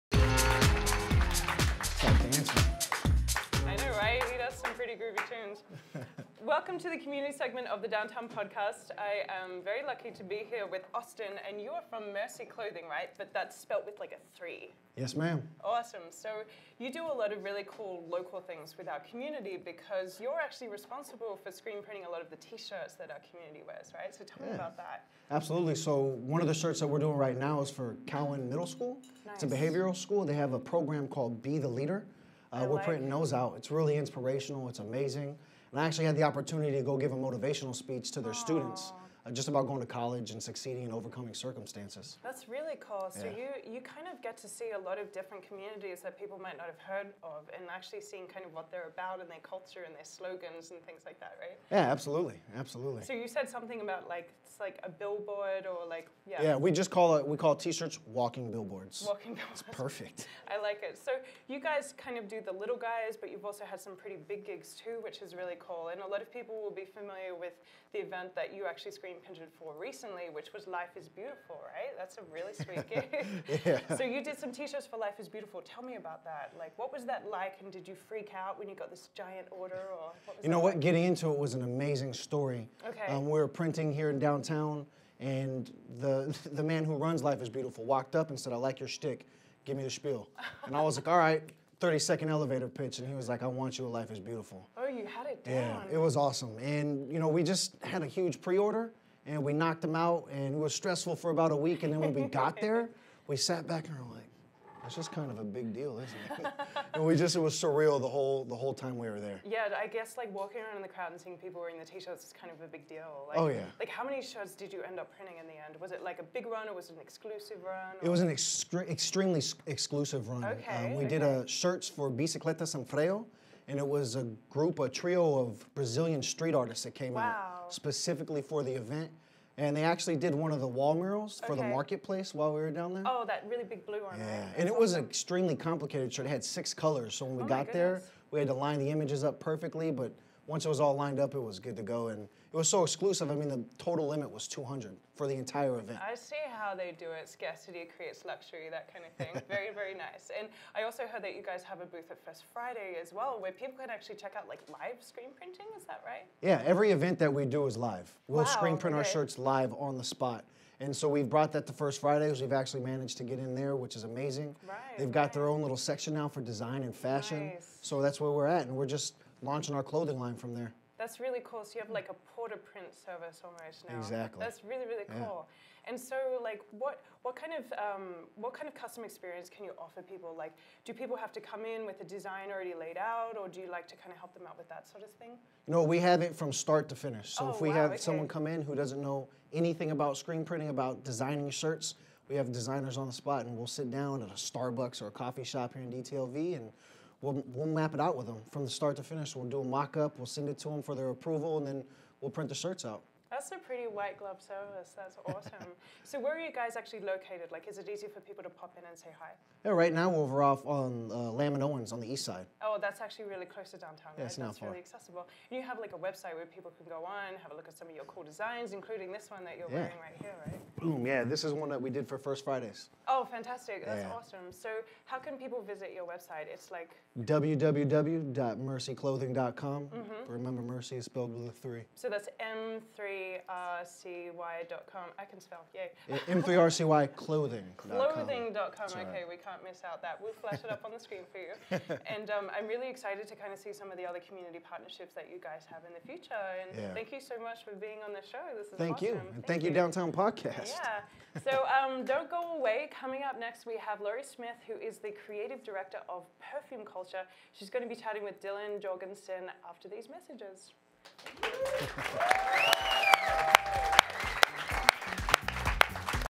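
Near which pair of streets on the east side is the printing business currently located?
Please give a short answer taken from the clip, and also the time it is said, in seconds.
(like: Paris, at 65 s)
Lamb and Owens, at 211 s.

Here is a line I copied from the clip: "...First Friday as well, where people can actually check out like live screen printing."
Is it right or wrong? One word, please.
right.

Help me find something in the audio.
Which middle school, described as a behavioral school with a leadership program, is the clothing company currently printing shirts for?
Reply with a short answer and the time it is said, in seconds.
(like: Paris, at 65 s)
Cowan Middle School, at 28 s.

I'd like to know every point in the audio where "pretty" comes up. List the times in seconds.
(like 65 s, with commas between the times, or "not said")
63 s, 203 s.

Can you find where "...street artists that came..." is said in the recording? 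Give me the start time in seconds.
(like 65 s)
126 s.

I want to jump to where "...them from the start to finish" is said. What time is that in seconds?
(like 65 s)
198 s.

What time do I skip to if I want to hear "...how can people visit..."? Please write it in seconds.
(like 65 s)
225 s.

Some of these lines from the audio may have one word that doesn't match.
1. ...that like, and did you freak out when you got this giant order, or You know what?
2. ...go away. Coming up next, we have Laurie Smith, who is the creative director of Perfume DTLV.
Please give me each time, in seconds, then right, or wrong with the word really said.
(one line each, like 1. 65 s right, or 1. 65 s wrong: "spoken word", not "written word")
1. 77 s right
2. 252 s wrong: "Culture", not "DTLV".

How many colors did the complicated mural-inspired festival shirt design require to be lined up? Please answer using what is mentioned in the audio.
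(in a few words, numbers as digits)
6.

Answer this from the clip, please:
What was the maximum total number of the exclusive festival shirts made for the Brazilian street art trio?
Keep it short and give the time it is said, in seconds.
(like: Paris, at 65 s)
200, at 144 s.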